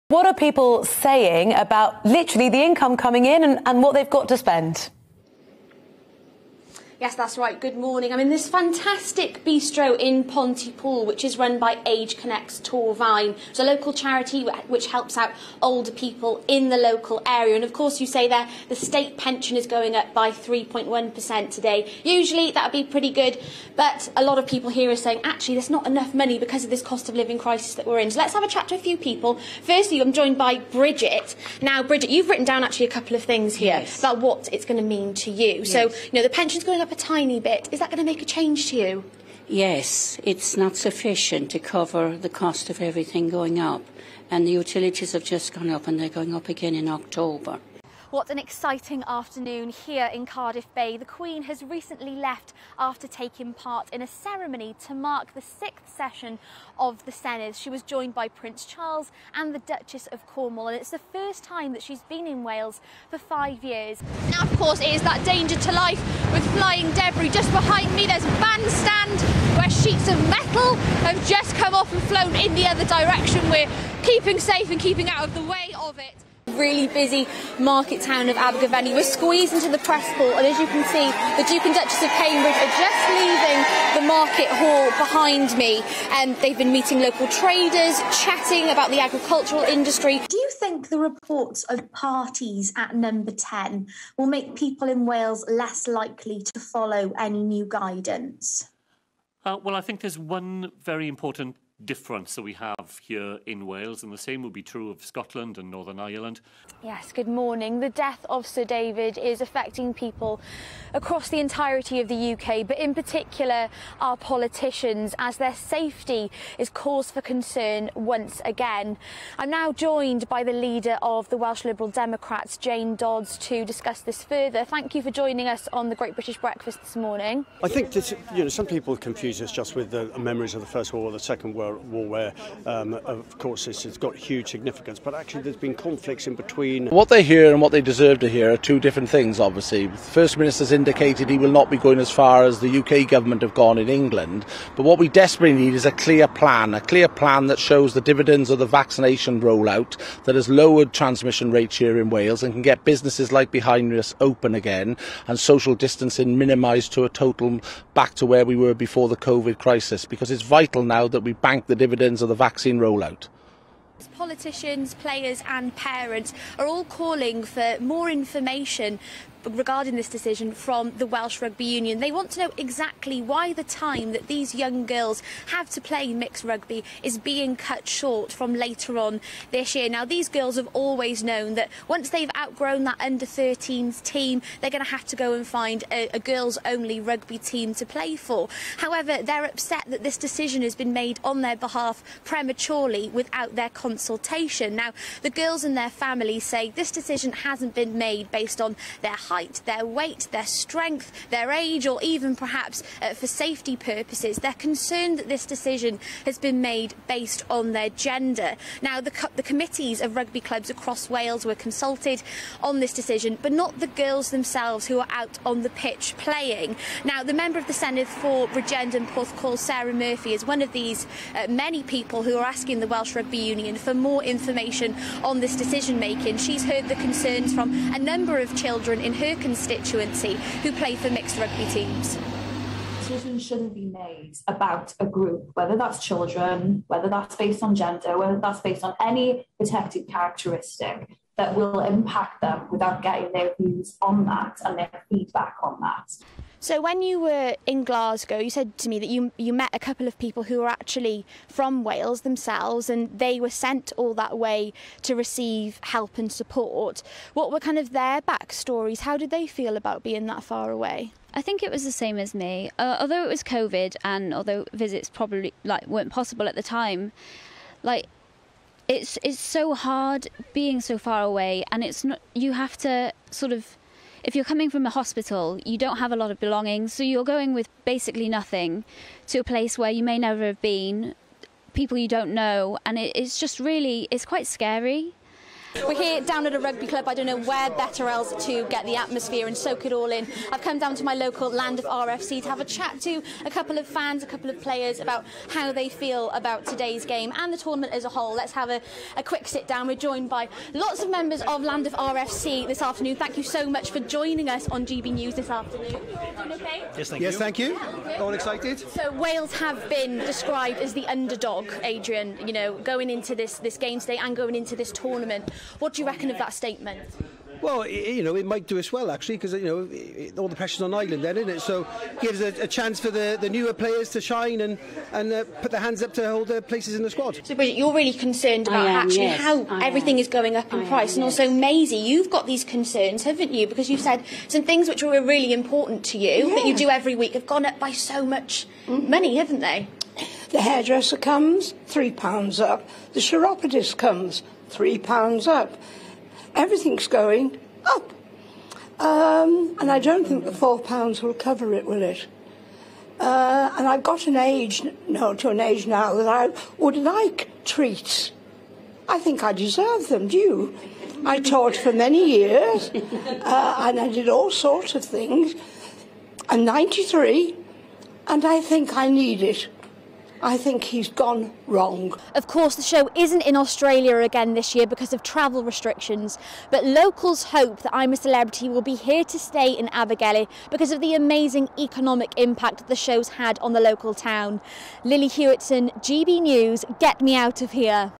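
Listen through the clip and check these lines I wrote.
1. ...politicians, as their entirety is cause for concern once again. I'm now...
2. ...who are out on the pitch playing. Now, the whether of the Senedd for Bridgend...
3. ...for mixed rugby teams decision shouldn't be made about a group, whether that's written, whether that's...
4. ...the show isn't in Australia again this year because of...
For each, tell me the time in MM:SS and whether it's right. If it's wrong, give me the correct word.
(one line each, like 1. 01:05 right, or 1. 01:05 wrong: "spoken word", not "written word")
1. 01:54 wrong: "safety", not "entirety"
2. 03:34 wrong: "member", not "whether"
3. 03:50 wrong: "children", not "written"
4. 06:12 right.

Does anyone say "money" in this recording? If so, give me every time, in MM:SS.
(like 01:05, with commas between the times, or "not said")
00:26, 05:39.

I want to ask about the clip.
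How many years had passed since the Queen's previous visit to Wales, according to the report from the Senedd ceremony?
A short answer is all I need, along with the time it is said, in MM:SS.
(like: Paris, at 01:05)
5, at 01:03.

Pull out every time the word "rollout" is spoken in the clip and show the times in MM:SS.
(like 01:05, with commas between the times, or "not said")
02:29, 02:42.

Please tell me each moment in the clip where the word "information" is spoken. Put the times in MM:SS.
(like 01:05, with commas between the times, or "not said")
02:48, 03:44.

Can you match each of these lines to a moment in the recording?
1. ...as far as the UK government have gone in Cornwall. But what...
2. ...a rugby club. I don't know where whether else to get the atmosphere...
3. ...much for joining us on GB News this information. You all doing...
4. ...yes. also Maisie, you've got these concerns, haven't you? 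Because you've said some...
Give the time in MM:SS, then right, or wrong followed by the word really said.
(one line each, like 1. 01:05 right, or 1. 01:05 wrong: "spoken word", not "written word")
1. 02:21 wrong: "England", not "Cornwall"
2. 04:46 wrong: "better", not "whether"
3. 05:03 wrong: "afternoon", not "information"
4. 05:31 right.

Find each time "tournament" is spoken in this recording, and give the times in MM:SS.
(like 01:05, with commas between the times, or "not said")
04:57, 05:14.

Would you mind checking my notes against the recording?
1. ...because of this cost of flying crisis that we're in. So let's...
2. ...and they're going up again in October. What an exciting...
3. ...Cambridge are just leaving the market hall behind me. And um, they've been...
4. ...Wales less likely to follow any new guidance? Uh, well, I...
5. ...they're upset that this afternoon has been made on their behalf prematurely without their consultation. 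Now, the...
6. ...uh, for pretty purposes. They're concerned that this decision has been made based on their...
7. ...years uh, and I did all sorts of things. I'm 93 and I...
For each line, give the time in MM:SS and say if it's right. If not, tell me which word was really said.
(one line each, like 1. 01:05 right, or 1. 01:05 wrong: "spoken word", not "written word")
1. 00:26 wrong: "living", not "flying"
2. 00:45 right
3. 01:22 right
4. 01:35 right
5. 03:09 wrong: "decision", not "afternoon"
6. 03:23 wrong: "safety", not "pretty"
7. 06:02 right.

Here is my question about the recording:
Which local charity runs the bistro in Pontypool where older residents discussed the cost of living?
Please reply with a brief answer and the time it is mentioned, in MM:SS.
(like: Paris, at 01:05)
Age Connects Torfaen, at 00:11.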